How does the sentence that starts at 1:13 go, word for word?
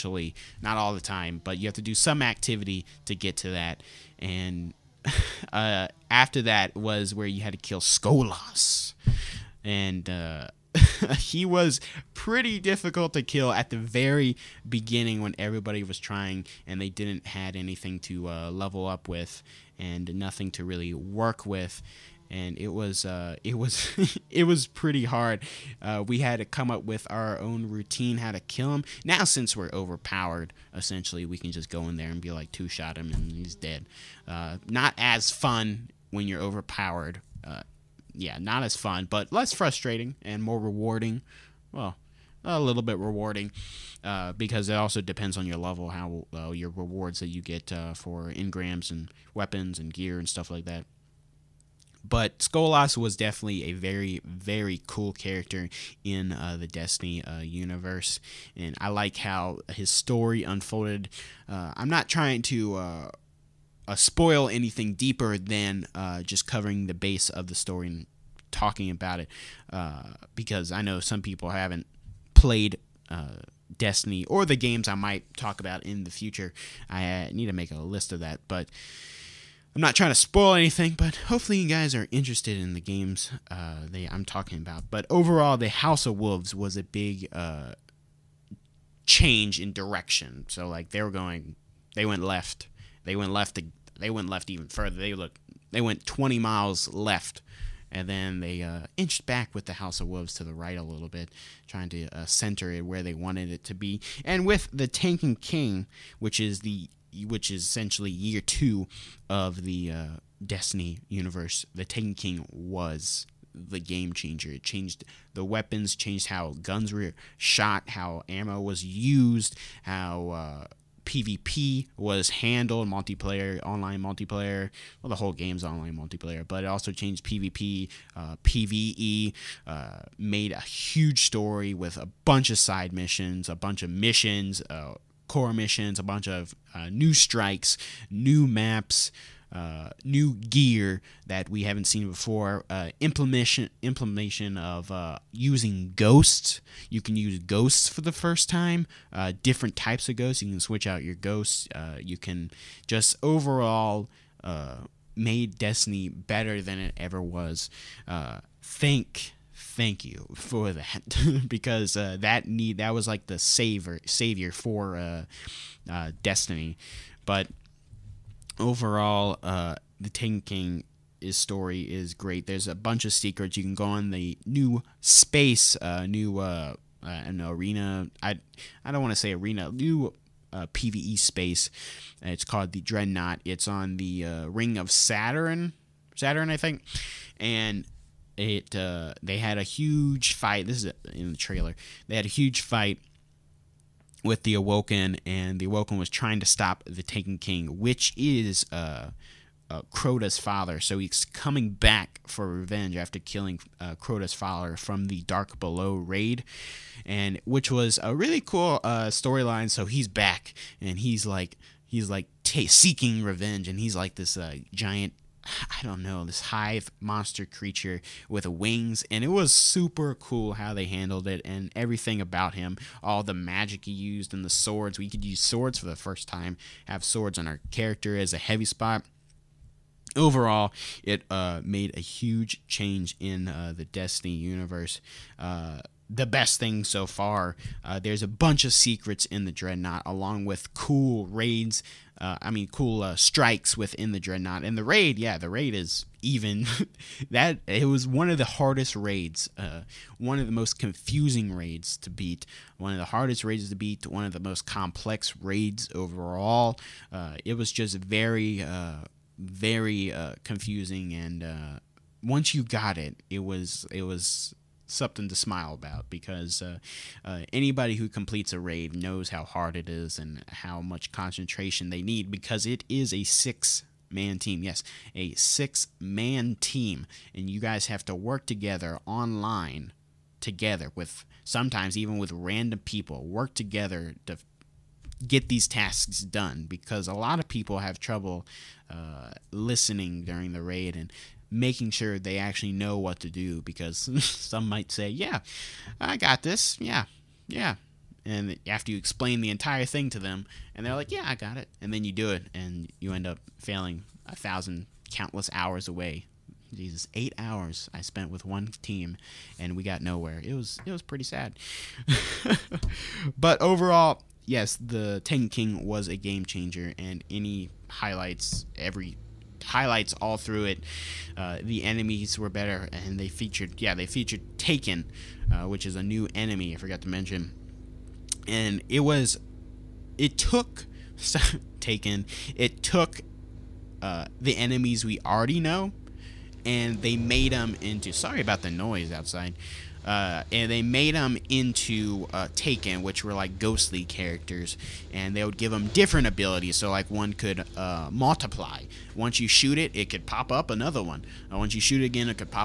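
Uh, Destiny or the games I might talk about in the future.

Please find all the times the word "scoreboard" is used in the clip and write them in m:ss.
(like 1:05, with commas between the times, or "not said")
not said.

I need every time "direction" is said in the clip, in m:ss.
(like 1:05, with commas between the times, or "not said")
1:29.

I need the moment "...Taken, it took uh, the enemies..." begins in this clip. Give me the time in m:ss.
5:31.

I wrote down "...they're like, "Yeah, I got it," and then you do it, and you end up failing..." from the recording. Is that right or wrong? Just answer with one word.
right.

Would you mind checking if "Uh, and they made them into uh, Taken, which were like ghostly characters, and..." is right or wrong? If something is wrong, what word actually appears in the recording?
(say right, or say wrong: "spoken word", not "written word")
right.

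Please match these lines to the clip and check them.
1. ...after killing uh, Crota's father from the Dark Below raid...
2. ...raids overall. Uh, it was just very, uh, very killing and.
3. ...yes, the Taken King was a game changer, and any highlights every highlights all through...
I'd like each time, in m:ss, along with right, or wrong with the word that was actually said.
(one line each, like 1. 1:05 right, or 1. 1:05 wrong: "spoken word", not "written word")
1. 3:22 right
2. 4:15 wrong: "confusing", not "killing"
3. 5:14 right.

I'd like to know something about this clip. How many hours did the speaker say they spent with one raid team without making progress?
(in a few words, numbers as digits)
8.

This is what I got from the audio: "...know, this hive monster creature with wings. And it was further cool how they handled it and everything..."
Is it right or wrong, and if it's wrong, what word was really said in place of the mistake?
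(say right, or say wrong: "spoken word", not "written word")
wrong: "super", not "further".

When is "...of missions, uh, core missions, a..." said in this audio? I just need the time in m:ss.
2:13.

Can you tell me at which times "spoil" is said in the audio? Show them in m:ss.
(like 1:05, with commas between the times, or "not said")
1:03, 1:20.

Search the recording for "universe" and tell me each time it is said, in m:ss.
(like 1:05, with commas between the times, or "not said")
0:57, 1:51, 3:54.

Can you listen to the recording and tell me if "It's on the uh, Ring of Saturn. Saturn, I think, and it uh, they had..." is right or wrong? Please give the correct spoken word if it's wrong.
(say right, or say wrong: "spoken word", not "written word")
right.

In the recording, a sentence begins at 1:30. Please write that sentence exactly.
So like they were going, they went left, they went left.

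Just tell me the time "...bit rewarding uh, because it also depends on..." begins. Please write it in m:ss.
0:42.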